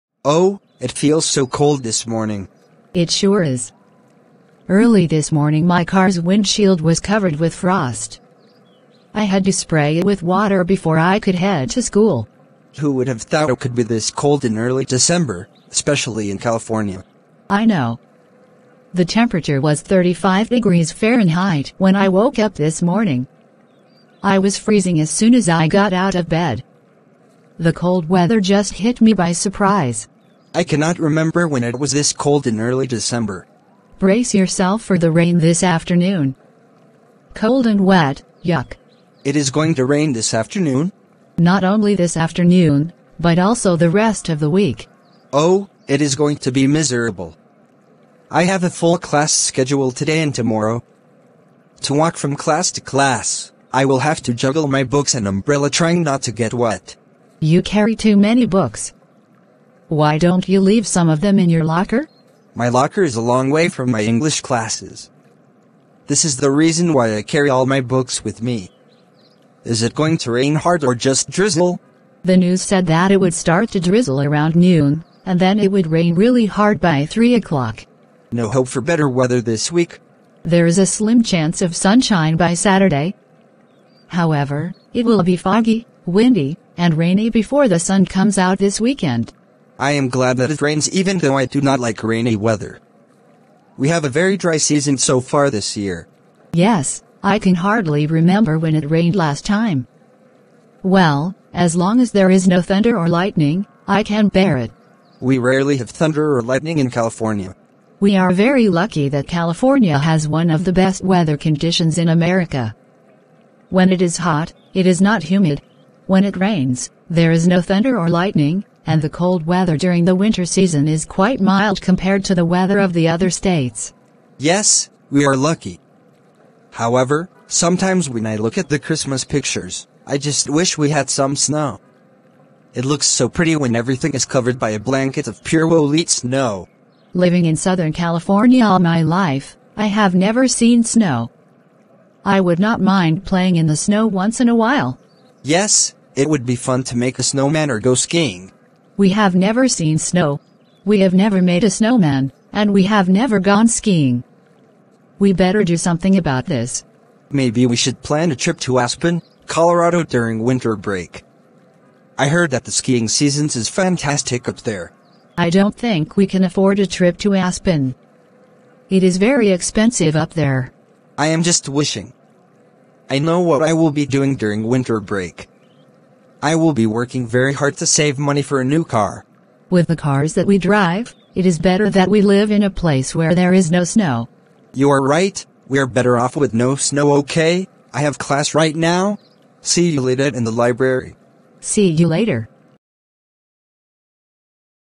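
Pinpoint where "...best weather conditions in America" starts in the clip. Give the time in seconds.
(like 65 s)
110 s.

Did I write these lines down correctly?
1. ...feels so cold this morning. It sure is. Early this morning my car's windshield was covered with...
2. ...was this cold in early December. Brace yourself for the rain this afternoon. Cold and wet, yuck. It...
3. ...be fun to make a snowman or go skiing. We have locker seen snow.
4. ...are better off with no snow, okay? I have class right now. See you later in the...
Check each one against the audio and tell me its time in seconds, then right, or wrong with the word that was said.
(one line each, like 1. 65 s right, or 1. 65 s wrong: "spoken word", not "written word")
1. 0 s right
2. 31 s right
3. 146 s wrong: "never", not "locker"
4. 185 s right.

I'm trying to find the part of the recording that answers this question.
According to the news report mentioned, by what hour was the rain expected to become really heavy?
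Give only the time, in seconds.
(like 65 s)
77 s.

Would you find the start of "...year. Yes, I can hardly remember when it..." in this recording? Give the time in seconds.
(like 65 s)
95 s.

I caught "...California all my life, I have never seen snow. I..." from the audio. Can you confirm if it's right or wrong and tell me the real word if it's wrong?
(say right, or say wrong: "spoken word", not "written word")
right.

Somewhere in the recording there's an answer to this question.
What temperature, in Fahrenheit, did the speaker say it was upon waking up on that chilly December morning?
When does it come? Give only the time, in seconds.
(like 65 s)
19 s.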